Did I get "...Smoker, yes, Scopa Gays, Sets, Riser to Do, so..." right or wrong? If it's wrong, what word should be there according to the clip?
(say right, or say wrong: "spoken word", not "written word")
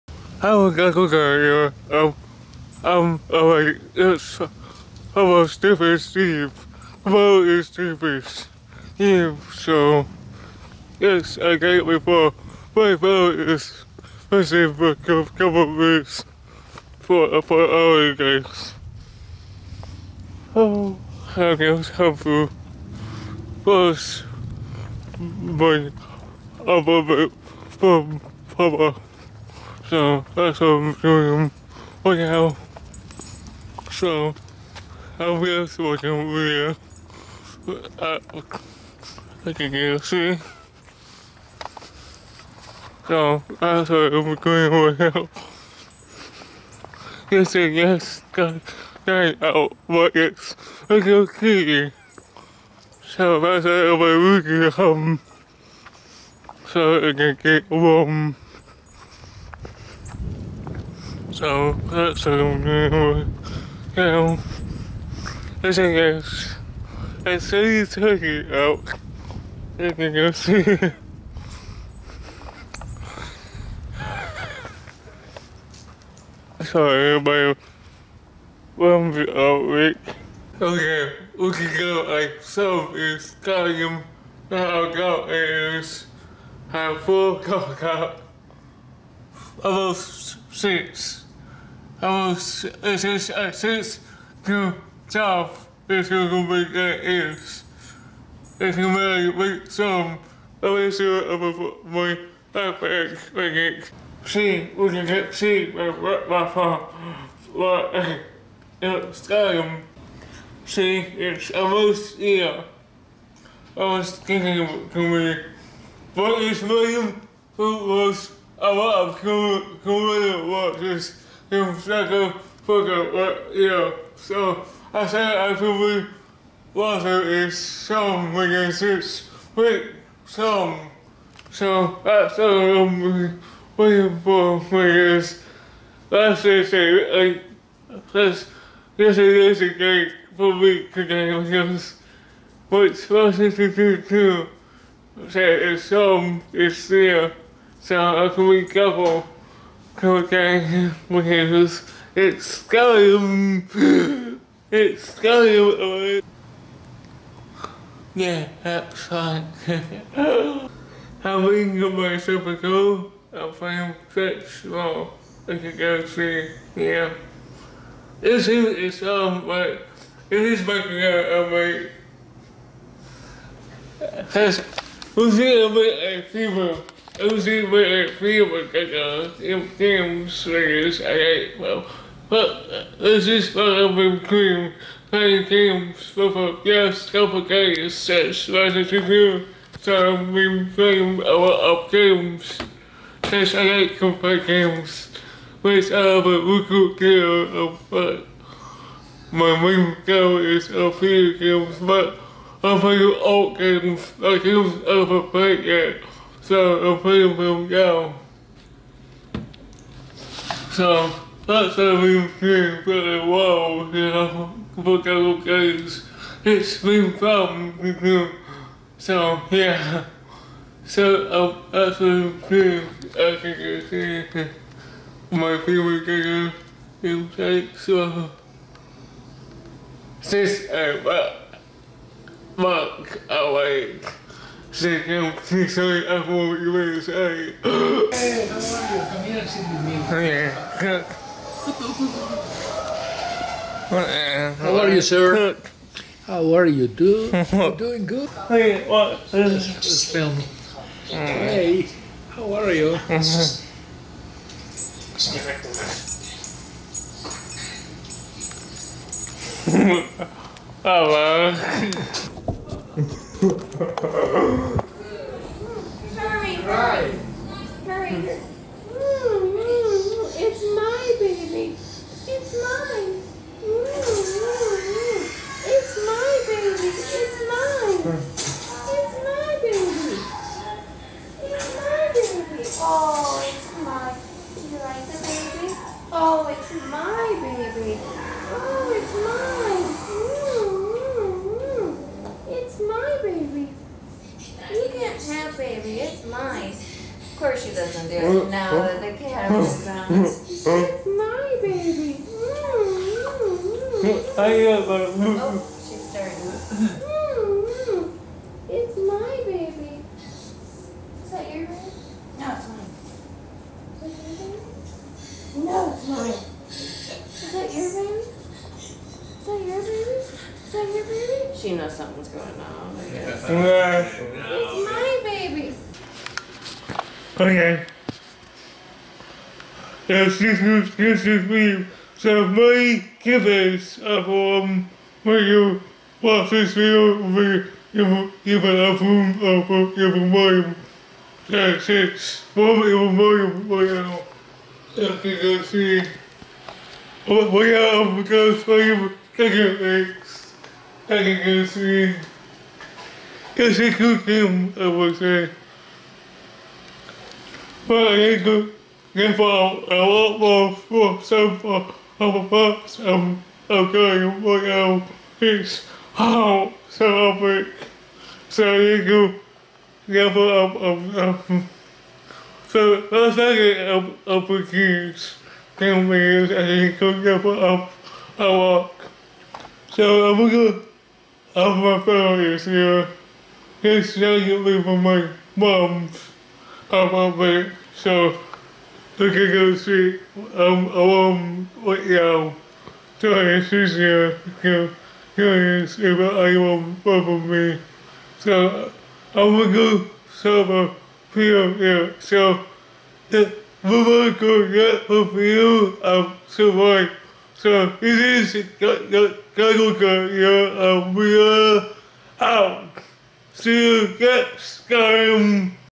right.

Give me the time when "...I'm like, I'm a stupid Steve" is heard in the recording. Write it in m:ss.
0:03.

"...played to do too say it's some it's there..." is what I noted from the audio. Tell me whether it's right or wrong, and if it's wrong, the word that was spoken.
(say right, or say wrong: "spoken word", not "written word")
wrong: "supposed", not "played".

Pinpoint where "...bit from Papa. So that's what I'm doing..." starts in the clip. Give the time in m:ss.
0:27.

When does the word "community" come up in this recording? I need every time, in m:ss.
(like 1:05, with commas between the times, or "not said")
1:59.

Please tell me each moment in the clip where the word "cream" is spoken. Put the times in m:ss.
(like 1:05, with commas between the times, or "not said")
3:04.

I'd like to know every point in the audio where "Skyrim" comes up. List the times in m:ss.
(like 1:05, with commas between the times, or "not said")
1:23.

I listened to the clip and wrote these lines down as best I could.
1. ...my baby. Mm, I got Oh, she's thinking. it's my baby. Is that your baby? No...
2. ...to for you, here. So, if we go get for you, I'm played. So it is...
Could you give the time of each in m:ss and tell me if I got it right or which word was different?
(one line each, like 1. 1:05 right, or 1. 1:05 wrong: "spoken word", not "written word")
1. 5:00 wrong: "starting", not "thinking"
2. 6:40 wrong: "survived", not "played".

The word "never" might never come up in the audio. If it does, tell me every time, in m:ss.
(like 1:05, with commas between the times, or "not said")
6:10, 6:17.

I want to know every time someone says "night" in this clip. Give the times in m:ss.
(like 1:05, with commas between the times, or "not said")
0:49, 6:13.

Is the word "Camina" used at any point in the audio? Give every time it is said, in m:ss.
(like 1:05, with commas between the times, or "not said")
3:57.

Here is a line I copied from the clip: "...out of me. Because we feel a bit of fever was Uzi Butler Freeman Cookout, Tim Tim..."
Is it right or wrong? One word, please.
right.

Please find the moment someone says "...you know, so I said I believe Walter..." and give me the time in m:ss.
2:03.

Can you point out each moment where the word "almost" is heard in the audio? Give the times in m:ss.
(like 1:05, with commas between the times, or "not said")
1:29, 1:51.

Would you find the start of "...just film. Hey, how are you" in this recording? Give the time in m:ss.
4:09.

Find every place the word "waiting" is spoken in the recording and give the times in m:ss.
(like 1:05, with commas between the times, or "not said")
2:13.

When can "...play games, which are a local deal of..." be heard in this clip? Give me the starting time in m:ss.
3:14.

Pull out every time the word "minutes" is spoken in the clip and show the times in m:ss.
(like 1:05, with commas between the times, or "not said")
0:15, 6:16.